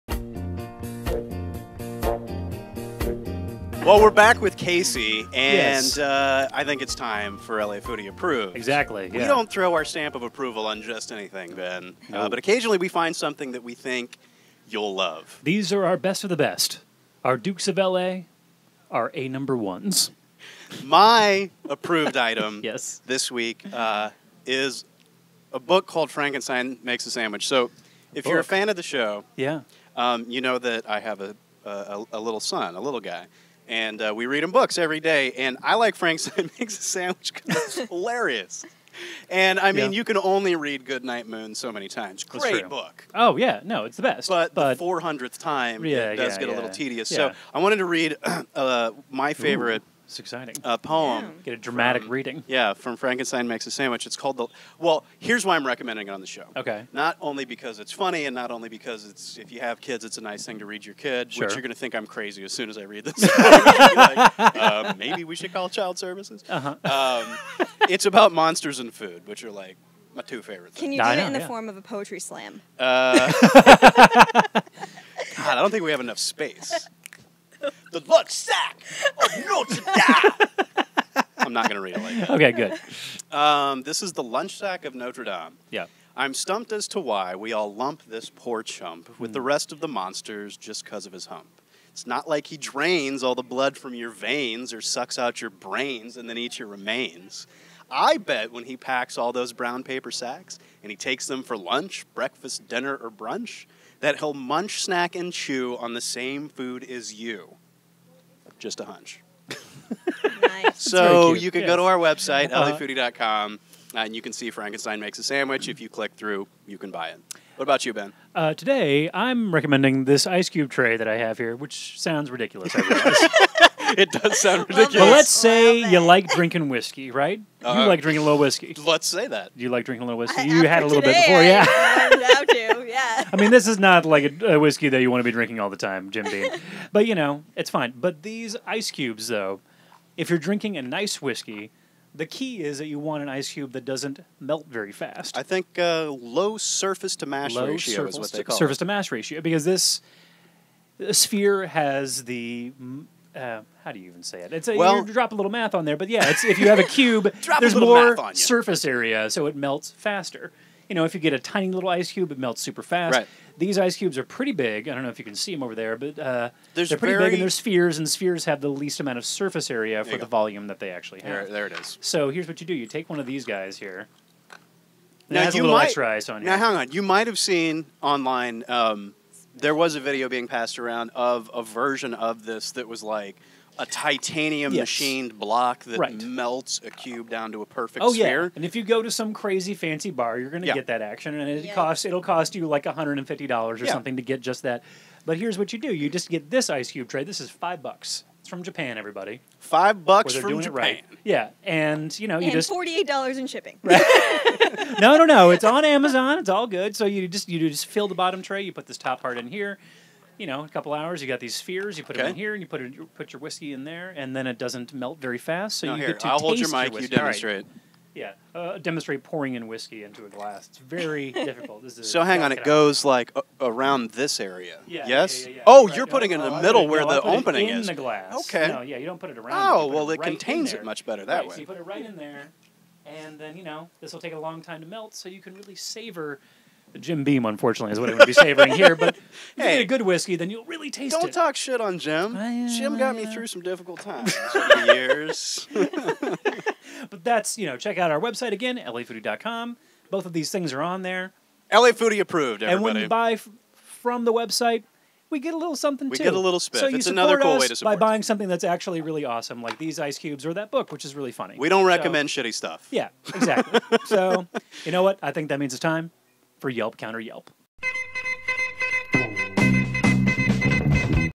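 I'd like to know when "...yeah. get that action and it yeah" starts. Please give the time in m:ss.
3:10.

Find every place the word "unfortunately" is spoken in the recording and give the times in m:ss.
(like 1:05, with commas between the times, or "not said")
3:57.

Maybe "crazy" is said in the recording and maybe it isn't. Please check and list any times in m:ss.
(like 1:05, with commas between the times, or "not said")
1:02, 3:09.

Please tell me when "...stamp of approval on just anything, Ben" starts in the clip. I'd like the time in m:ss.
0:09.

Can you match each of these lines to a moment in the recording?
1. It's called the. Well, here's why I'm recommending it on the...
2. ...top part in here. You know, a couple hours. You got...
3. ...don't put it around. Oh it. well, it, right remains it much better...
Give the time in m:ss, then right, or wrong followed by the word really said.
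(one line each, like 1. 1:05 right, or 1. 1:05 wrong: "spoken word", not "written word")
1. 0:54 right
2. 3:28 right
3. 3:49 wrong: "contains", not "remains".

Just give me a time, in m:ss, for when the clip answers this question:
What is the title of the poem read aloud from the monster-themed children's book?
1:24.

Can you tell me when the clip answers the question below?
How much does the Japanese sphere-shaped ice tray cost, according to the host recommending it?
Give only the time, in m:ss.
3:17.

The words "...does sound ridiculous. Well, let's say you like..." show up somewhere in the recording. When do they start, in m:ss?
2:04.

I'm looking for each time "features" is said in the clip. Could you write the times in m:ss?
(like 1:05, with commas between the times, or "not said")
not said.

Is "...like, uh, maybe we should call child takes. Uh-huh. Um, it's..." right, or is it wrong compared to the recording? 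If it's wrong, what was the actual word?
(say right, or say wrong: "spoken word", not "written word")
wrong: "services", not "takes".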